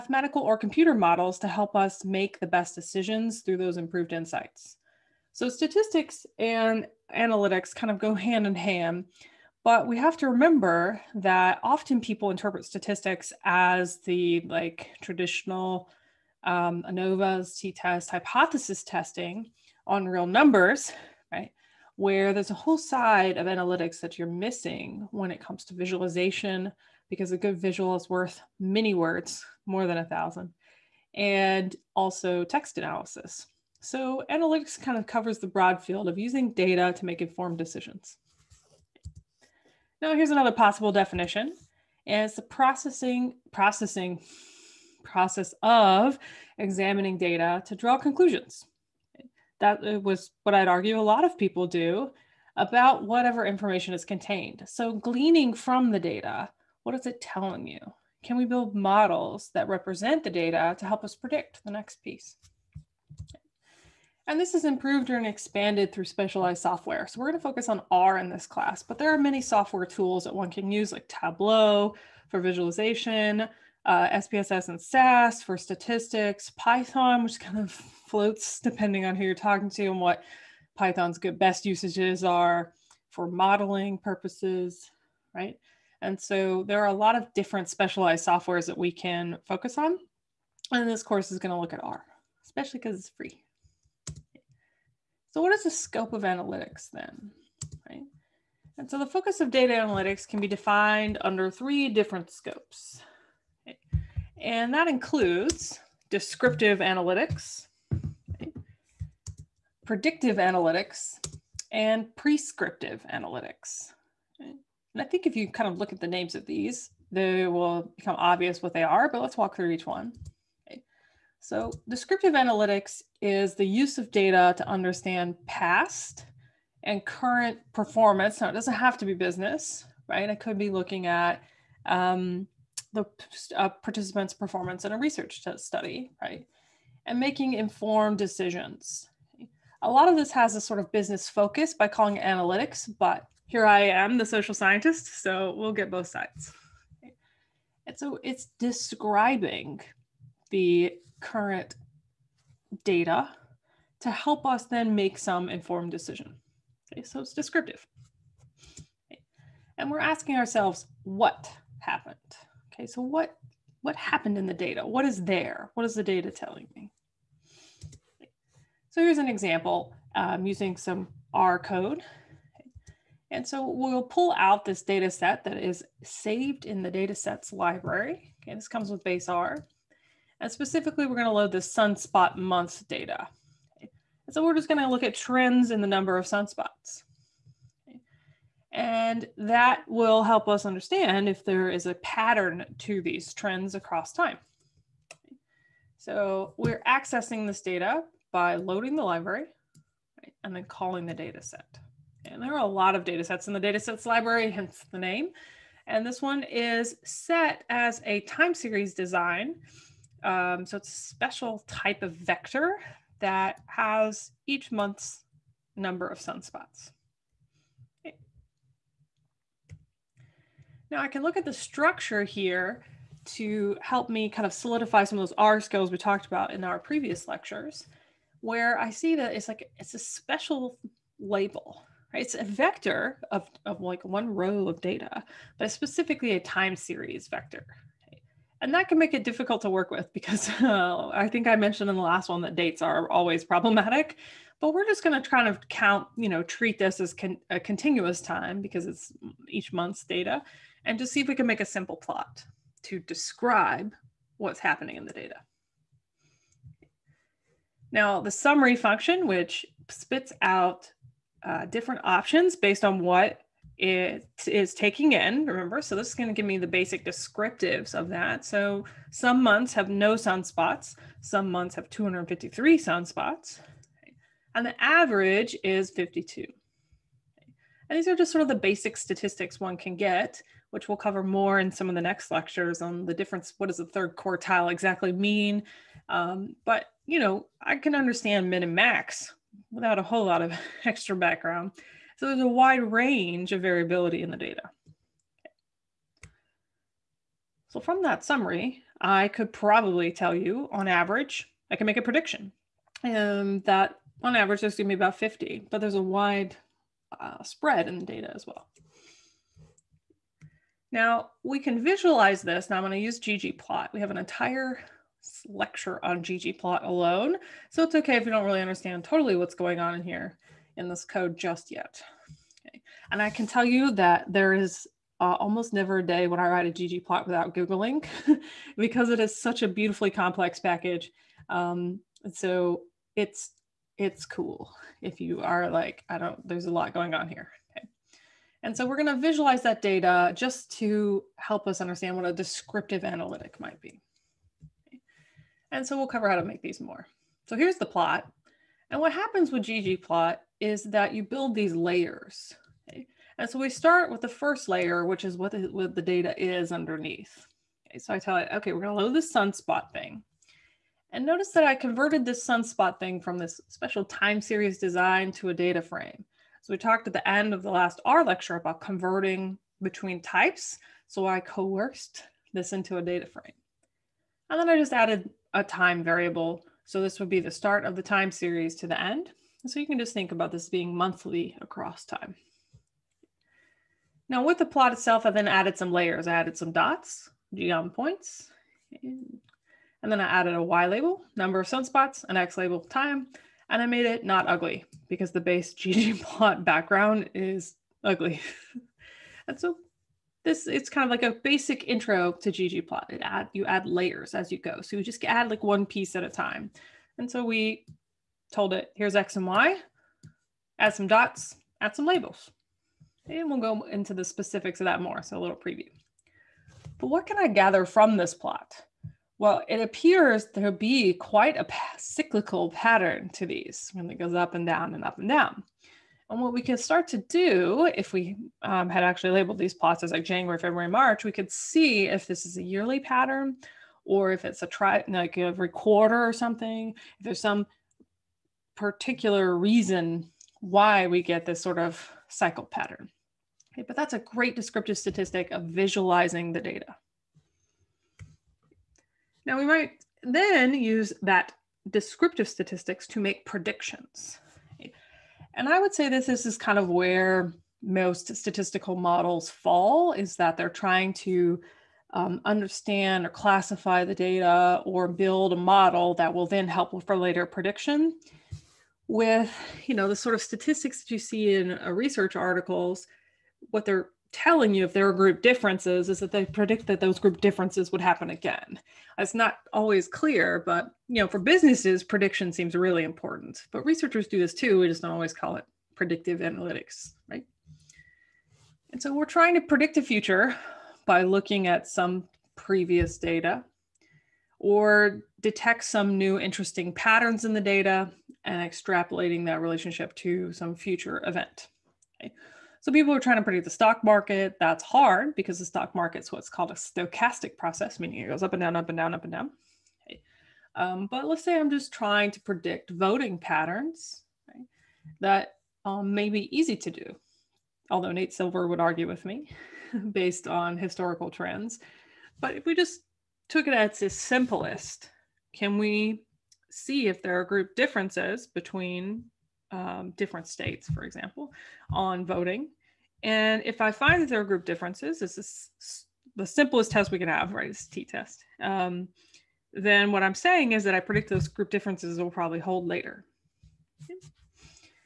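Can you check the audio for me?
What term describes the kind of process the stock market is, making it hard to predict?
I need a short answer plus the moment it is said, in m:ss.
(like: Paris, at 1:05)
stochastic process, at 8:26.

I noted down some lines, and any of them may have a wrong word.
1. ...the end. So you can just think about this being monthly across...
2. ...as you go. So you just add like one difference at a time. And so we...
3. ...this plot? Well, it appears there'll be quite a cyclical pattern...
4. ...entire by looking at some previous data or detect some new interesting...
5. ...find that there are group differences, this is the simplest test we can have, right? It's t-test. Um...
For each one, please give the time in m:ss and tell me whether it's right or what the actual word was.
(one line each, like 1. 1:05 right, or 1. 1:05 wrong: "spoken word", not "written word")
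1. 6:18 right
2. 6:44 wrong: "piece", not "difference"
3. 6:58 right
4. 8:10 wrong: "future", not "entire"
5. 8:53 right.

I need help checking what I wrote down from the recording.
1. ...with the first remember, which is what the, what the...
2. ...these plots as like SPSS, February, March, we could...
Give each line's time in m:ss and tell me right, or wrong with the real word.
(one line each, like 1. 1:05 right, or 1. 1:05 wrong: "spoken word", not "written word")
1. 5:54 wrong: "layer", not "remember"
2. 7:09 wrong: "January", not "SPSS".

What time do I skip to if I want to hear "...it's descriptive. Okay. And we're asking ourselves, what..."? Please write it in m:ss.
2:37.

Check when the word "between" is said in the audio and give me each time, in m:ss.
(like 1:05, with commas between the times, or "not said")
6:09, 8:48.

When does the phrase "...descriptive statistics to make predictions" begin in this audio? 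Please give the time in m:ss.
7:31.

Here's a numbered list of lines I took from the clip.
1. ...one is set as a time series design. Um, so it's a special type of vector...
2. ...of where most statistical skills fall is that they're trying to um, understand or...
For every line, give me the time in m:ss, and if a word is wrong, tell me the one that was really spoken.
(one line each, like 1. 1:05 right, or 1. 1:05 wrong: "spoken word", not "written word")
1. 3:26 right
2. 7:36 wrong: "models", not "skills".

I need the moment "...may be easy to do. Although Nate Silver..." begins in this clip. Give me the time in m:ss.
8:36.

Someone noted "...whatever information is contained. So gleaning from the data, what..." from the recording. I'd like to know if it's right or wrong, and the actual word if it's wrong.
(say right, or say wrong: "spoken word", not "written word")
right.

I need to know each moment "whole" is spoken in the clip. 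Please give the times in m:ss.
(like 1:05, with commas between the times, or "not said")
0:22, 4:50.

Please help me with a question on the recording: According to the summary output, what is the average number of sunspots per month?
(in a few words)
52.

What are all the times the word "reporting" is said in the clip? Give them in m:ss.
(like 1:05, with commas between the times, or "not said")
not said.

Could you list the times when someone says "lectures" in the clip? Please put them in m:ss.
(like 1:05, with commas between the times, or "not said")
3:47, 4:42, 5:15, 6:08.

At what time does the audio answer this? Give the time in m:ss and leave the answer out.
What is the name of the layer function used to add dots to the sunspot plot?
6:27.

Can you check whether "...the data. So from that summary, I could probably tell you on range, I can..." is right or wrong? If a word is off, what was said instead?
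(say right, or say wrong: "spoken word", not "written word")
wrong: "average", not "range".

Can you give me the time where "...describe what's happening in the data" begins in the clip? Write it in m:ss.
4:12.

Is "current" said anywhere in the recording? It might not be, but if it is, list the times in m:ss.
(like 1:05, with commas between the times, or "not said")
2:07, 2:31.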